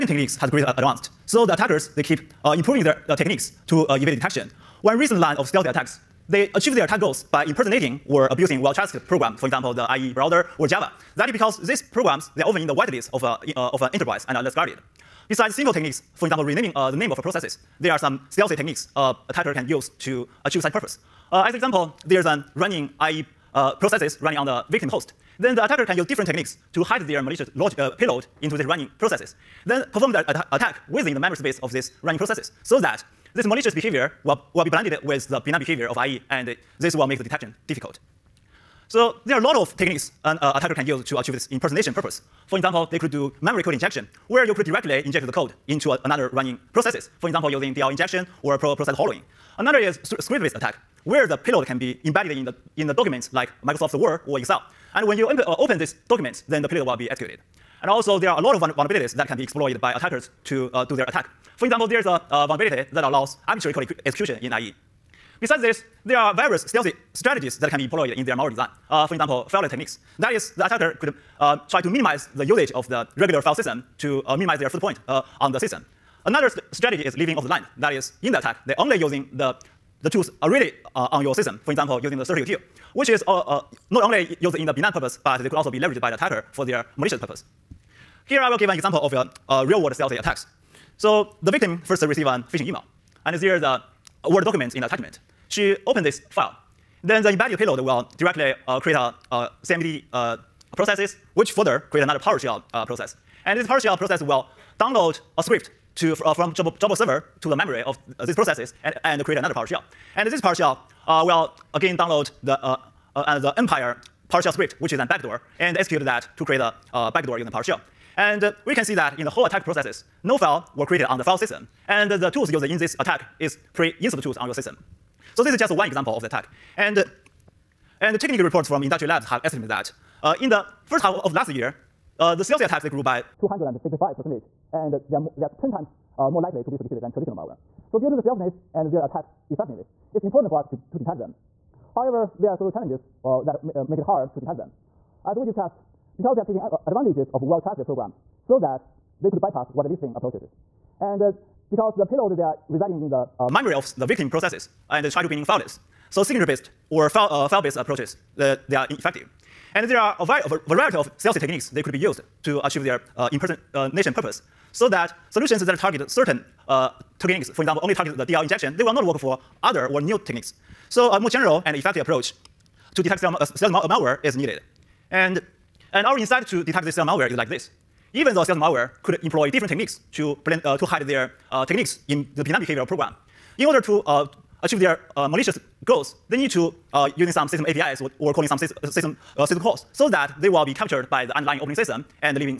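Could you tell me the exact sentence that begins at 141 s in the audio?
However, there are several challenges uh, that uh, make it hard to detect them.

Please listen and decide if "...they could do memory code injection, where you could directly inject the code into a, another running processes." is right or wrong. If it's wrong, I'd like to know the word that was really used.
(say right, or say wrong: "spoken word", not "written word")
right.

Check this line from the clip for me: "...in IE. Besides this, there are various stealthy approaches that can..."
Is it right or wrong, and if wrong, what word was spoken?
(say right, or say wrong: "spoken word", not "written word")
wrong: "strategies", not "approaches".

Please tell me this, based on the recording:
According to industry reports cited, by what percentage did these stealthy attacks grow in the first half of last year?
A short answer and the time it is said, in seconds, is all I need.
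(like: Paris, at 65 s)
265%, at 133 s.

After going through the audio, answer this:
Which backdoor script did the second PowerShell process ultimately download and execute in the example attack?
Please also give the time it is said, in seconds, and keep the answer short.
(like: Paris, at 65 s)
Empire PowerShell script, at 113 s.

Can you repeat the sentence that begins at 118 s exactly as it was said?
And uh, we can see that in the whole attack processes, no file were created on the file system.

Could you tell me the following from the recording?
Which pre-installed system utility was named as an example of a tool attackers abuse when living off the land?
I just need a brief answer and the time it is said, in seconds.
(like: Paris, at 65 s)
CertUtil, at 82 s.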